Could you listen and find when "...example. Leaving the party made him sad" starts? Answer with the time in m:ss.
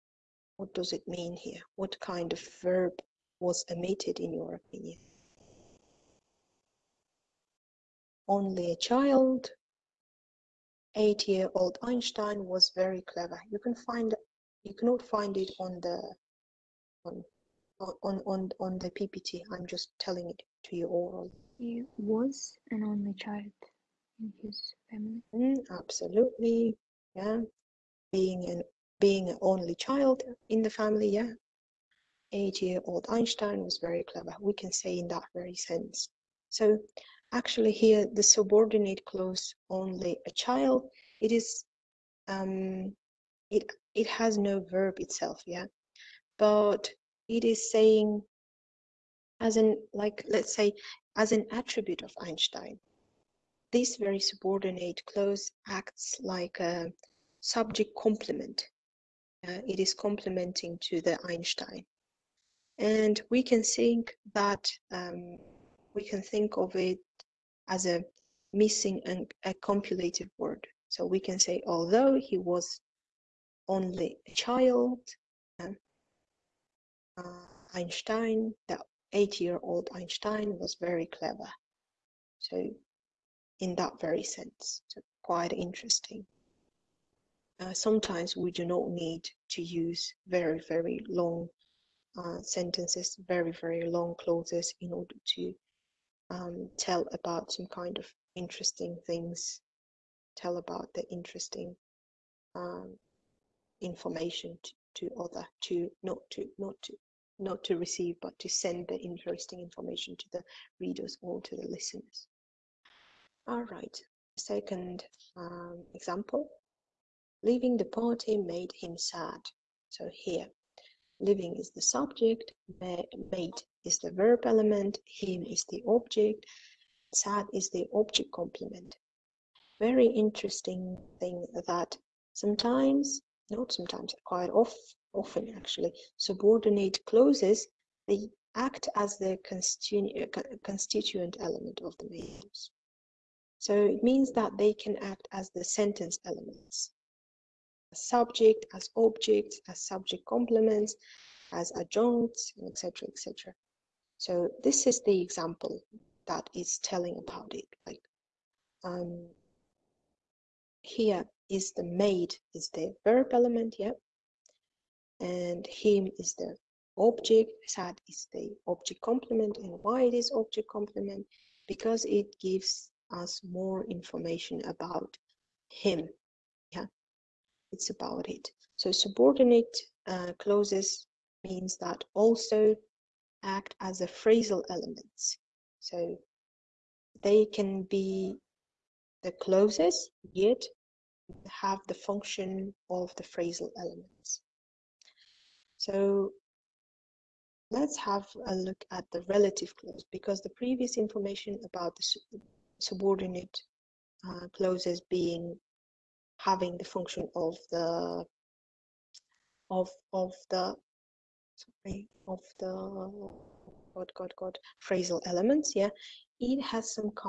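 1:55.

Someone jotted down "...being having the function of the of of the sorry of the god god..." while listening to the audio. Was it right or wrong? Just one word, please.
right.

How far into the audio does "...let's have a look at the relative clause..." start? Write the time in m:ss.
3:17.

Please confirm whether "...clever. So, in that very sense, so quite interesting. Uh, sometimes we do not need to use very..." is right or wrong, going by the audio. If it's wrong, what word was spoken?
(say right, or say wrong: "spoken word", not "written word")
right.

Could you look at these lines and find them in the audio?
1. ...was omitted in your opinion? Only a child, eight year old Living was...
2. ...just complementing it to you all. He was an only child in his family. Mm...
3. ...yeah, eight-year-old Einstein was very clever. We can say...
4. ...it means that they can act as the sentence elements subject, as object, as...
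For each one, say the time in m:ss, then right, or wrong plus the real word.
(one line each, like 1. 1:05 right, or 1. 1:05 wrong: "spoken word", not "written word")
1. 0:03 wrong: "Einstein", not "Living"
2. 0:19 wrong: "telling", not "complementing"
3. 0:31 right
4. 2:23 right.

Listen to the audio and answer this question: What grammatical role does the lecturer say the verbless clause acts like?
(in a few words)
subject complement.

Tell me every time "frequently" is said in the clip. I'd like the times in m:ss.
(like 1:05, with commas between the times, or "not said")
not said.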